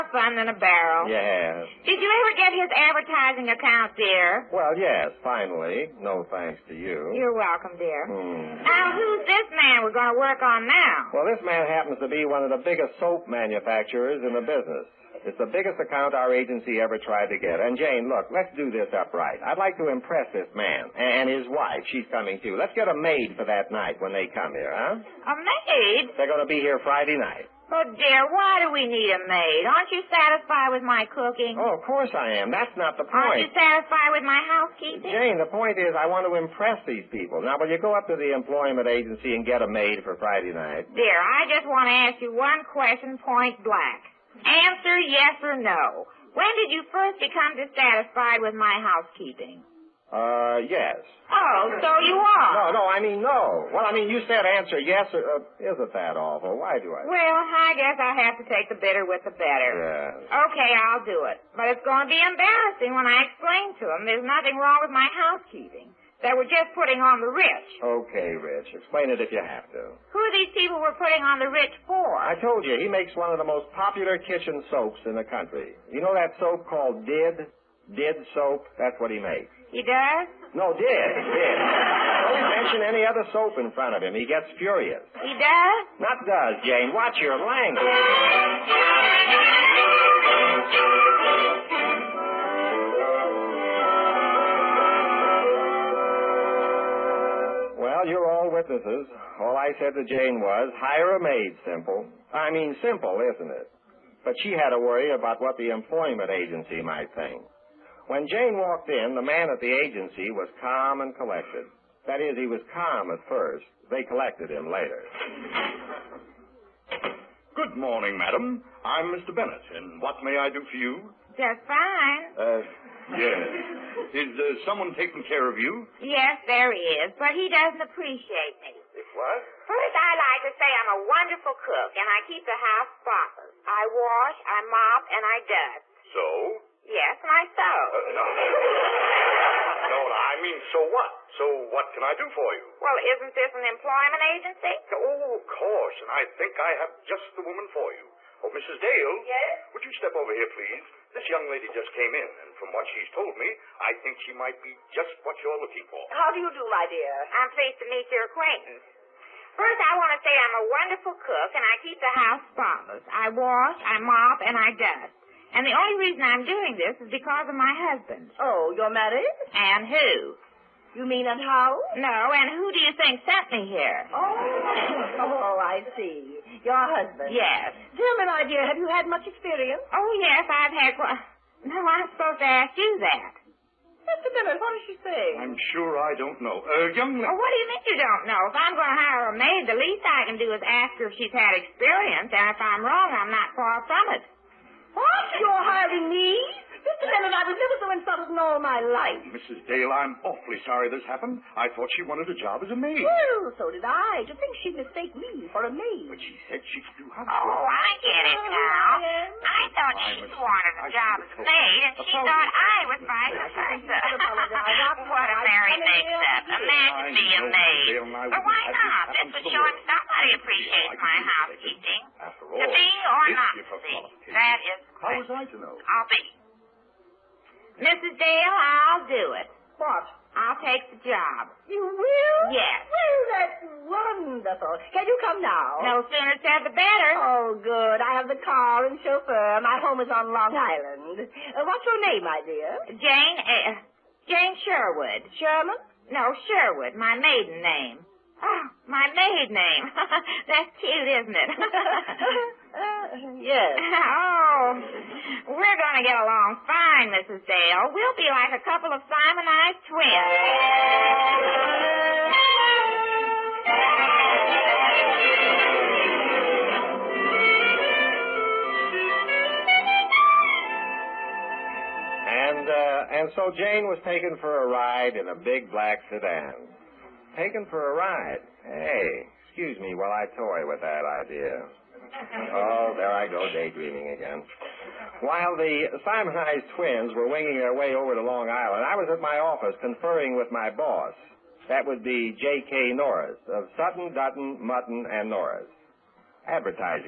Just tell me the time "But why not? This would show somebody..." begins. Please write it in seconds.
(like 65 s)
218 s.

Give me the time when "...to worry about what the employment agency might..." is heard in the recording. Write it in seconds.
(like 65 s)
104 s.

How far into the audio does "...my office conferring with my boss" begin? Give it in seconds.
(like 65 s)
289 s.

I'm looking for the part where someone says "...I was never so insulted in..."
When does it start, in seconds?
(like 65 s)
197 s.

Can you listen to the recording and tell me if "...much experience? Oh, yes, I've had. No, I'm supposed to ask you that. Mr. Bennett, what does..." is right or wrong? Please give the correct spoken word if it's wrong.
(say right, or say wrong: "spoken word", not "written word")
right.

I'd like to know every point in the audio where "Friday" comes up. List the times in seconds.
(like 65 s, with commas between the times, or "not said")
26 s, 40 s.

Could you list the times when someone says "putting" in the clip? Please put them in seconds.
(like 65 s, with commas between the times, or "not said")
66 s, 70 s.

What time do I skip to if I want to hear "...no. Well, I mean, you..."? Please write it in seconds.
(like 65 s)
53 s.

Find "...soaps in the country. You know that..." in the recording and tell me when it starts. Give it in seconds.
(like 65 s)
74 s.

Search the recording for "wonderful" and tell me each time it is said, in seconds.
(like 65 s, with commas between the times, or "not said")
131 s, 160 s, 233 s.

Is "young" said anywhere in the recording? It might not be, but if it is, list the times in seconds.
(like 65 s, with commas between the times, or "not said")
151 s, 186 s.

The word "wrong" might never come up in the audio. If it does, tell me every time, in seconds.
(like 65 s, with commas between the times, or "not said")
64 s, 192 s.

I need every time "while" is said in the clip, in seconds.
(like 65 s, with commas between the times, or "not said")
279 s, 285 s.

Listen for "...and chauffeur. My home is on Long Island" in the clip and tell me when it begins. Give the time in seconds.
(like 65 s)
238 s.